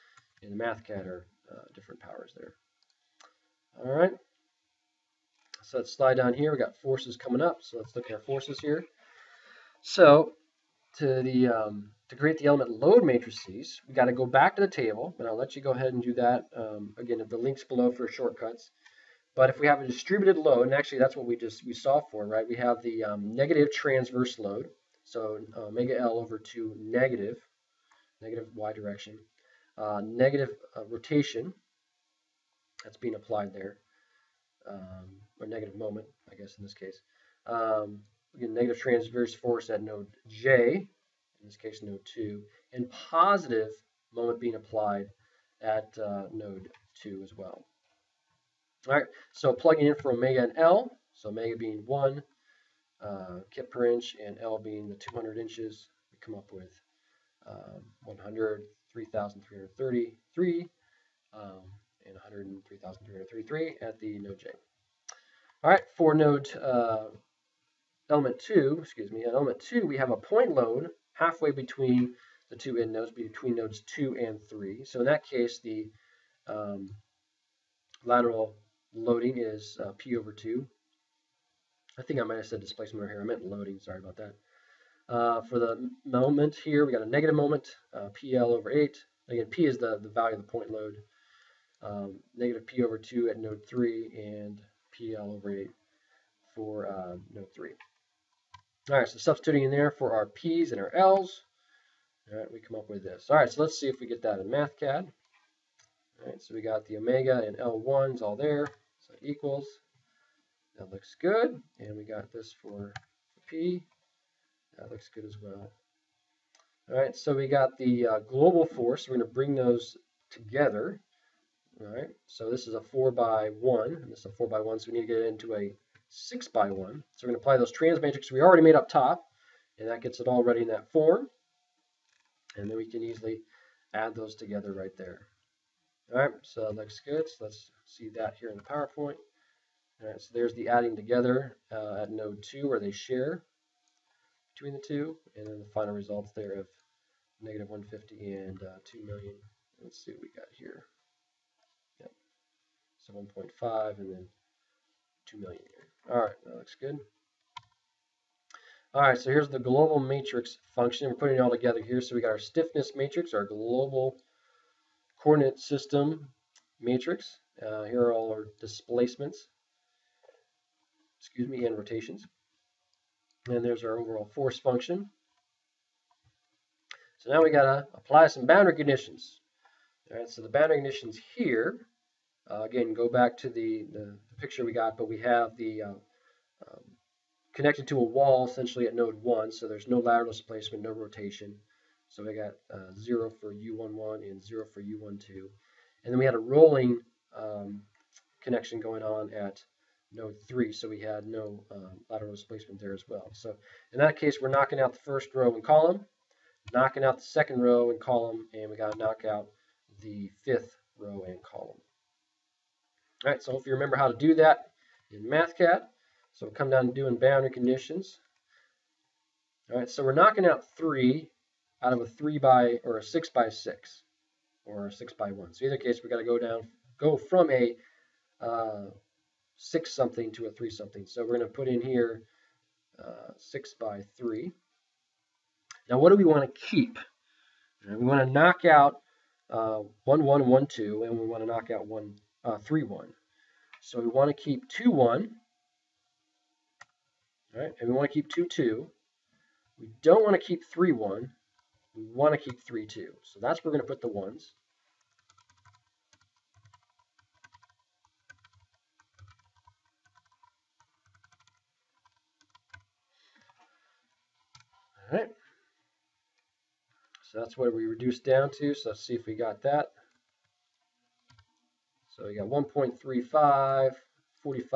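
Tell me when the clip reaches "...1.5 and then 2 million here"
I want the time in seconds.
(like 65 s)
153 s.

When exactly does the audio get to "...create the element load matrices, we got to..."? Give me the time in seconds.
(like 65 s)
12 s.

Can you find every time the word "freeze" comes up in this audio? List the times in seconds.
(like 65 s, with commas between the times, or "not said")
not said.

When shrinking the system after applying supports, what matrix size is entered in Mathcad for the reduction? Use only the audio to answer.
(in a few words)
6 by 3.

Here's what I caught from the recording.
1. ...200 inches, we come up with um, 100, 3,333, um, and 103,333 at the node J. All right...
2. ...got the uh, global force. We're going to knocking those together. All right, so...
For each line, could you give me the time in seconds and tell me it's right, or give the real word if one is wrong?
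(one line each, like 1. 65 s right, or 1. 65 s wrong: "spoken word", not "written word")
1. 54 s right
2. 117 s wrong: "bring", not "knocking".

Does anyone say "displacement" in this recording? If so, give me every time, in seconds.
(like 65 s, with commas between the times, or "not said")
82 s, 168 s, 190 s, 202 s.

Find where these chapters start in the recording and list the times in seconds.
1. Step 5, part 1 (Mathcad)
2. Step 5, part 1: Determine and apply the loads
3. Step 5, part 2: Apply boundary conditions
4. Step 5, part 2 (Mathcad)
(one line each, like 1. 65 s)
1. 104 s
2. 8 s
3. 176 s
4. 214 s.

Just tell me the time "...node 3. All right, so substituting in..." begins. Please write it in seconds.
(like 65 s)
97 s.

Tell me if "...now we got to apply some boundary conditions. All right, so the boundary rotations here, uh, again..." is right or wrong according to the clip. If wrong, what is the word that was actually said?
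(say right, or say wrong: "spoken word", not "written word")
wrong: "conditions", not "rotations".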